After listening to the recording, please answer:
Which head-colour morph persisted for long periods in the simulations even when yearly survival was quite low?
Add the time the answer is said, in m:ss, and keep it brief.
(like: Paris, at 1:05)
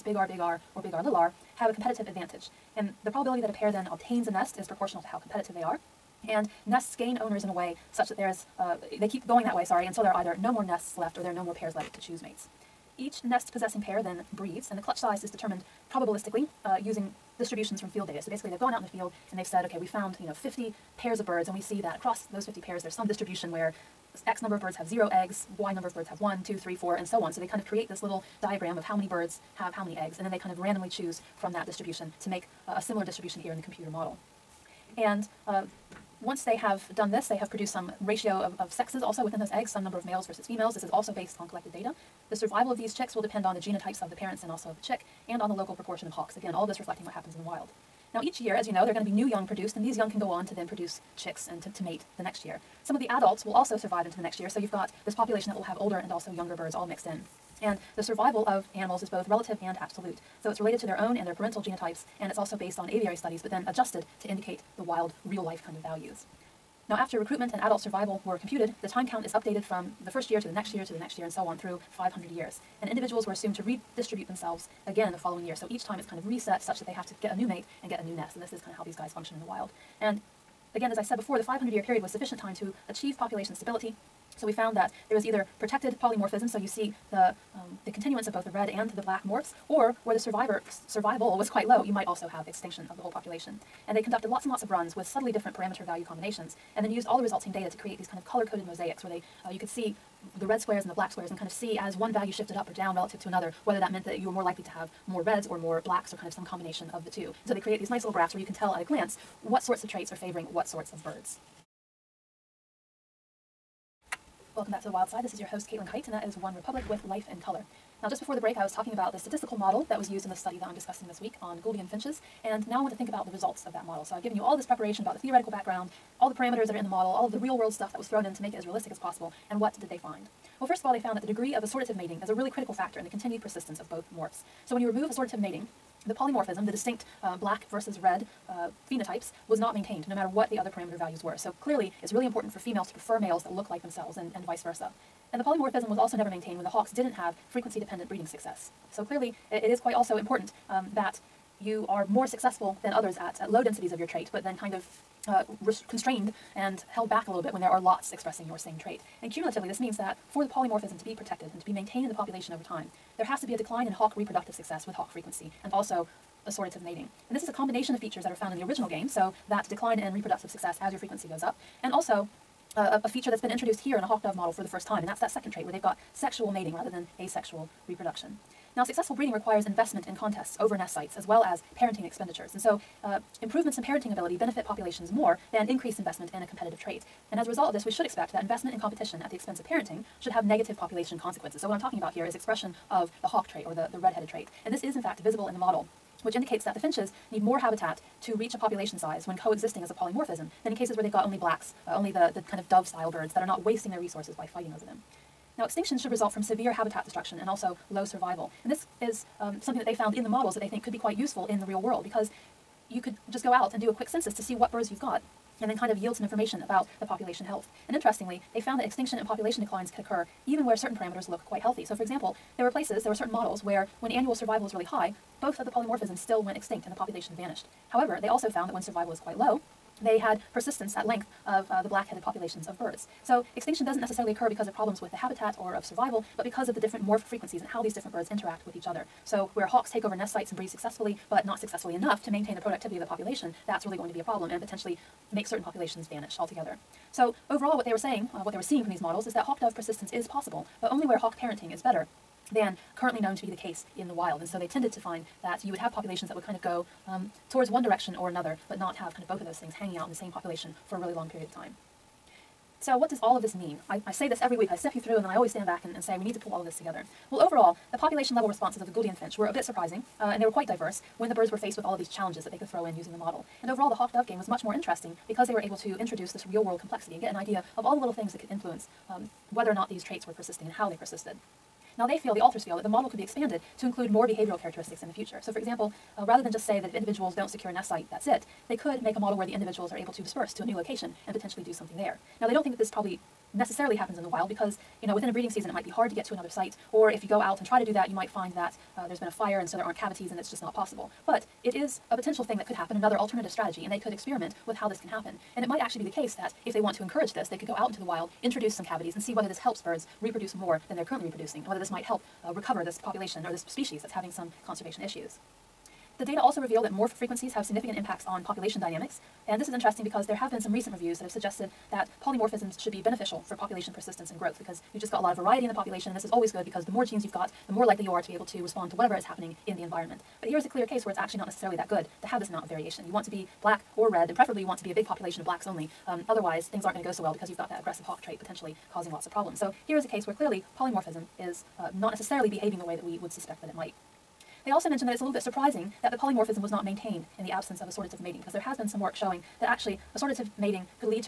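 Black-headed, at 3:51.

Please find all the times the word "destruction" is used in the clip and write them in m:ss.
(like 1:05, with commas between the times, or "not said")
3:27.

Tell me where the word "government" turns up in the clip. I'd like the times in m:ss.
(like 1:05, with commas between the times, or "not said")
not said.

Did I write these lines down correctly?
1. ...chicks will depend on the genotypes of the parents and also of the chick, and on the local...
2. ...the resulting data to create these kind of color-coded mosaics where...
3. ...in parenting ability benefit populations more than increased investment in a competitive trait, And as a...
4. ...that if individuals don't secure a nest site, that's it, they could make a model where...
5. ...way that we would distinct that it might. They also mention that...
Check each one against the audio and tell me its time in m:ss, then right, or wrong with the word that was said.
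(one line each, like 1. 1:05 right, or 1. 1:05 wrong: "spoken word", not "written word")
1. 0:42 right
2. 1:37 right
3. 3:03 right
4. 4:46 right
5. 5:42 wrong: "suspect", not "distinct".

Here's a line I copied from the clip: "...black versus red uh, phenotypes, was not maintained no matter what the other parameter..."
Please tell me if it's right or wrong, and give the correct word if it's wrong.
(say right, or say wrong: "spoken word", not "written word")
right.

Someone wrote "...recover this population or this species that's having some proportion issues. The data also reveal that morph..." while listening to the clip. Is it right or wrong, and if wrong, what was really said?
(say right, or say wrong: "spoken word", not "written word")
wrong: "conservation", not "proportion".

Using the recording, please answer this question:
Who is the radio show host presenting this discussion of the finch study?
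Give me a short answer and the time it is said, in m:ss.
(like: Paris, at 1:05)
Caitlin Kight, at 1:55.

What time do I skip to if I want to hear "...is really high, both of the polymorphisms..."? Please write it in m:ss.
3:44.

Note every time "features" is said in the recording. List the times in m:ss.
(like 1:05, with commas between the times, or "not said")
2:47, 2:53.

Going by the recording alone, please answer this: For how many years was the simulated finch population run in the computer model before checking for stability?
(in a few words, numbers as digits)
500.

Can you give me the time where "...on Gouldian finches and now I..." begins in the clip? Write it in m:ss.
2:01.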